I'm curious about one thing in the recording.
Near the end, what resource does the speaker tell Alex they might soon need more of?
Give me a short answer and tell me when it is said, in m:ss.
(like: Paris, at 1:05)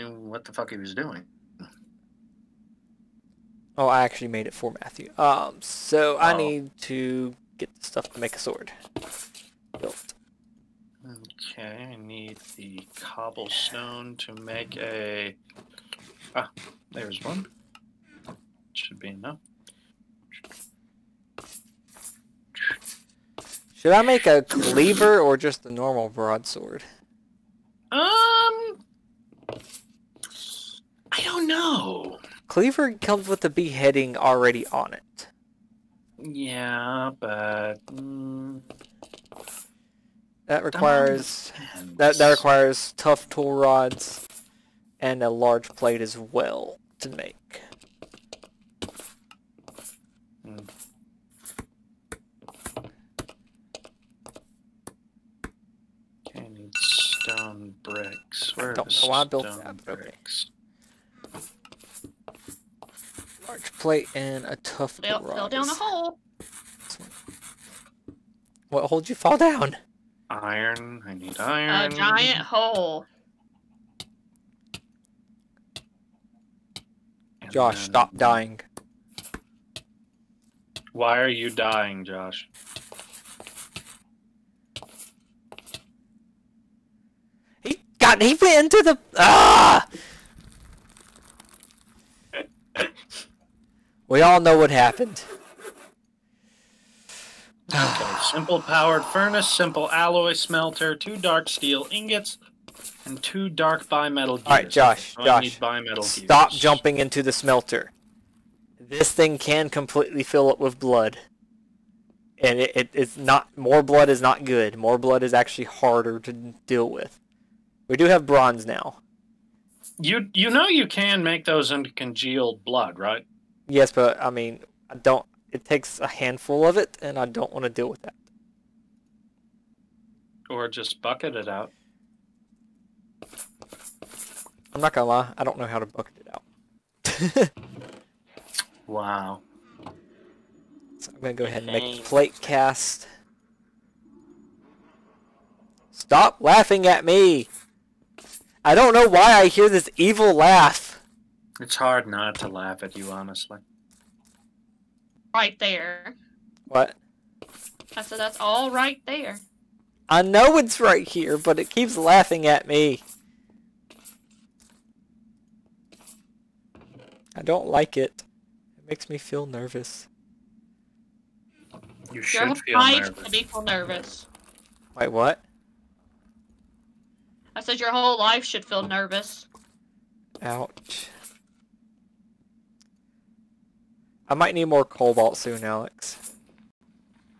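Cobalt, at 3:04.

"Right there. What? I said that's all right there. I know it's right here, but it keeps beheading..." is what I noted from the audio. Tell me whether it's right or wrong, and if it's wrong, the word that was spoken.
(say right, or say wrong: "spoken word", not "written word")
wrong: "laughing", not "beheading".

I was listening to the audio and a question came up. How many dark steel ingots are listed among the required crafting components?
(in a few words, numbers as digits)
2.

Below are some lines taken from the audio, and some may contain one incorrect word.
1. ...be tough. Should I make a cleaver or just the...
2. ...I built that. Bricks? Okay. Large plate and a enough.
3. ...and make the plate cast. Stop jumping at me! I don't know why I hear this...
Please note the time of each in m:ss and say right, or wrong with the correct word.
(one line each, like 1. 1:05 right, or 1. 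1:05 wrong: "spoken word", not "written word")
1. 0:18 wrong: "enough", not "tough"
2. 0:59 wrong: "tough", not "enough"
3. 2:21 wrong: "laughing", not "jumping".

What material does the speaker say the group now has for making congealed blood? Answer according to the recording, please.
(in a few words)
Bronze.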